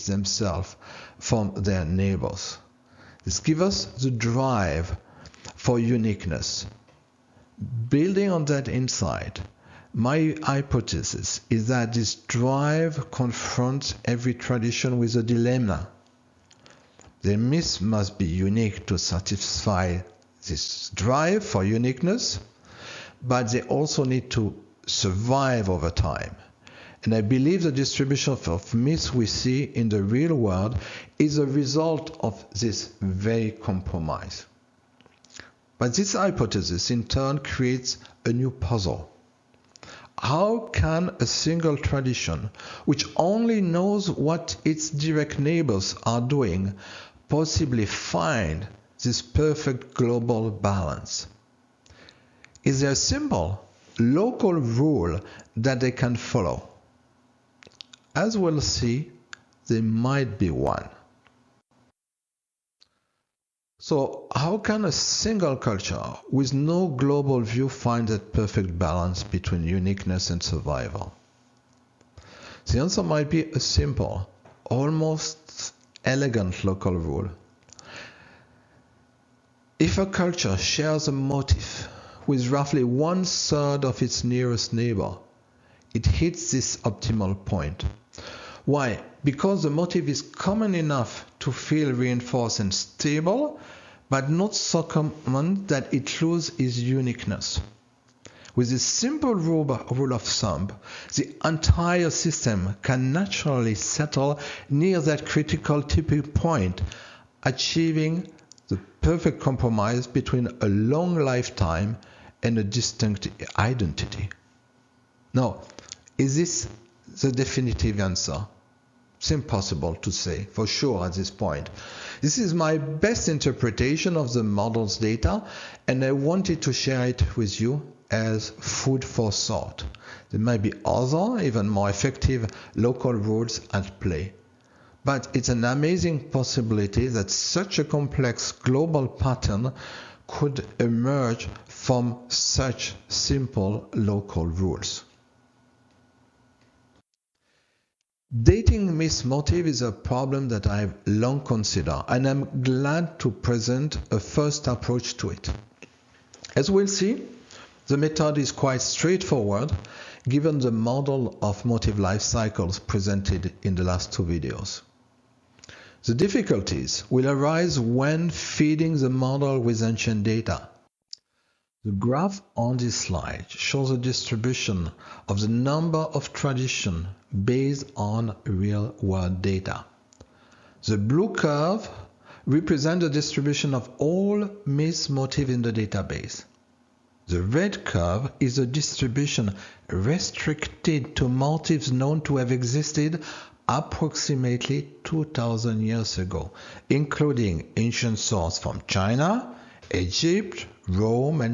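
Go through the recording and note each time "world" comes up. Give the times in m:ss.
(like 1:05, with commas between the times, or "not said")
0:30, 2:58.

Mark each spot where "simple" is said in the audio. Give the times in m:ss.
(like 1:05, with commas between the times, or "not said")
0:52, 1:13, 1:38, 2:23.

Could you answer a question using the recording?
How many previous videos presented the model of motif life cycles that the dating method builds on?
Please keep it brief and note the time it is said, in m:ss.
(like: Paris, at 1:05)
2, at 2:44.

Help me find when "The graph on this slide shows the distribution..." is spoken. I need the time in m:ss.
2:51.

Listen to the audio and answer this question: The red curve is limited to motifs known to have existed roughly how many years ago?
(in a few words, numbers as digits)
2000.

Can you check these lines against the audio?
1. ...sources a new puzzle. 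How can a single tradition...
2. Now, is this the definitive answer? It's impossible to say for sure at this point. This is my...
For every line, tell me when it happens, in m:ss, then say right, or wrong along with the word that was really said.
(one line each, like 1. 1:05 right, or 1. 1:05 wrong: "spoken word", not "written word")
1. 0:37 wrong: "creates", not "sources"
2. 1:55 right.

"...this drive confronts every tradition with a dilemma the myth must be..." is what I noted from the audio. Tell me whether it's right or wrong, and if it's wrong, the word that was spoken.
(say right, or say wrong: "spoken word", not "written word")
right.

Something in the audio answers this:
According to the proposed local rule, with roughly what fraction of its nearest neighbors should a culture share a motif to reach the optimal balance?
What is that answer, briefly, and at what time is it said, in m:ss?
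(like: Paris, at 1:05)
one third, at 1:22.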